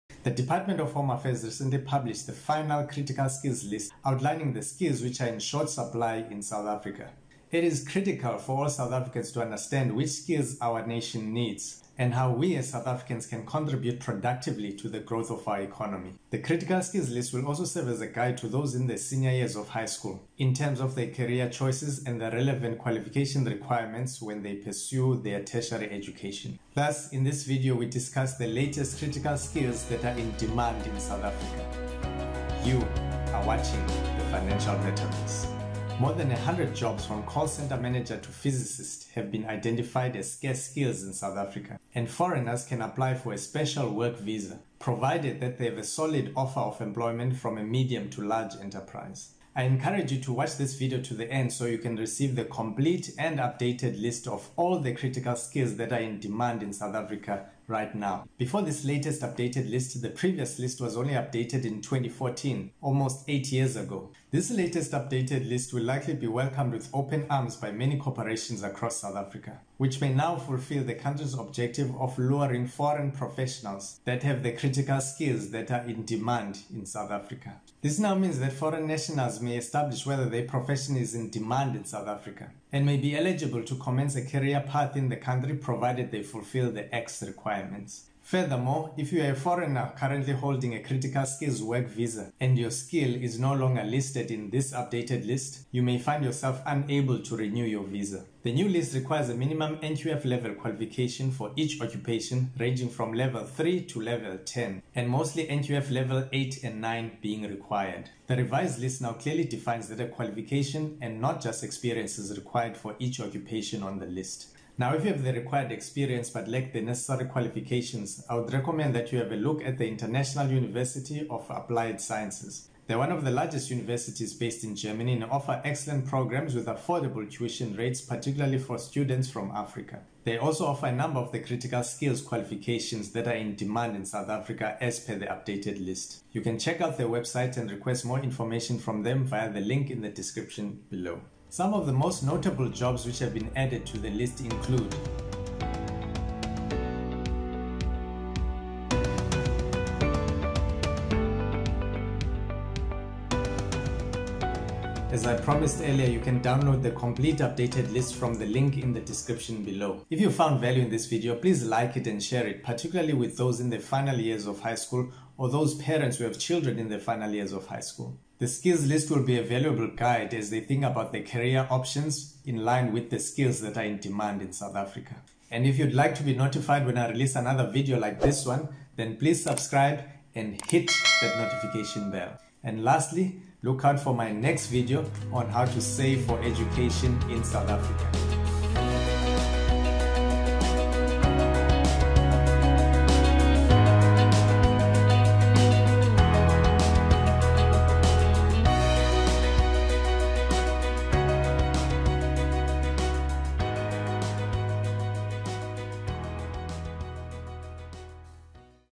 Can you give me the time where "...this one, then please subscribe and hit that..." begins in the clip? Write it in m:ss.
2:58.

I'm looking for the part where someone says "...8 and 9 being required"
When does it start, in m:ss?
1:46.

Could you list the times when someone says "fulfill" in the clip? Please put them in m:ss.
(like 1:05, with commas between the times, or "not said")
1:10, 1:26.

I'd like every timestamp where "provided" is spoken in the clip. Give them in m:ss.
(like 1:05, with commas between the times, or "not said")
0:44, 1:25.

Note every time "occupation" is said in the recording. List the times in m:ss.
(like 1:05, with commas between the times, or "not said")
1:41, 1:53.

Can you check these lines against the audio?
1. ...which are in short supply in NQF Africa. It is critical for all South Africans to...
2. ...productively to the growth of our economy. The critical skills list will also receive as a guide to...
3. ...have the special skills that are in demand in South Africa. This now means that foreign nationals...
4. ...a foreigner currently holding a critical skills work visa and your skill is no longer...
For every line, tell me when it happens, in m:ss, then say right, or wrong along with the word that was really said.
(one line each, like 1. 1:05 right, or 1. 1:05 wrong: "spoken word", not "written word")
1. 0:05 wrong: "South", not "NQF"
2. 0:13 wrong: "serve", not "receive"
3. 1:14 wrong: "critical", not "special"
4. 1:29 right.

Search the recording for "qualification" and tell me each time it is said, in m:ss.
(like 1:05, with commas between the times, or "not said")
0:22, 1:40, 1:50, 1:57, 2:12.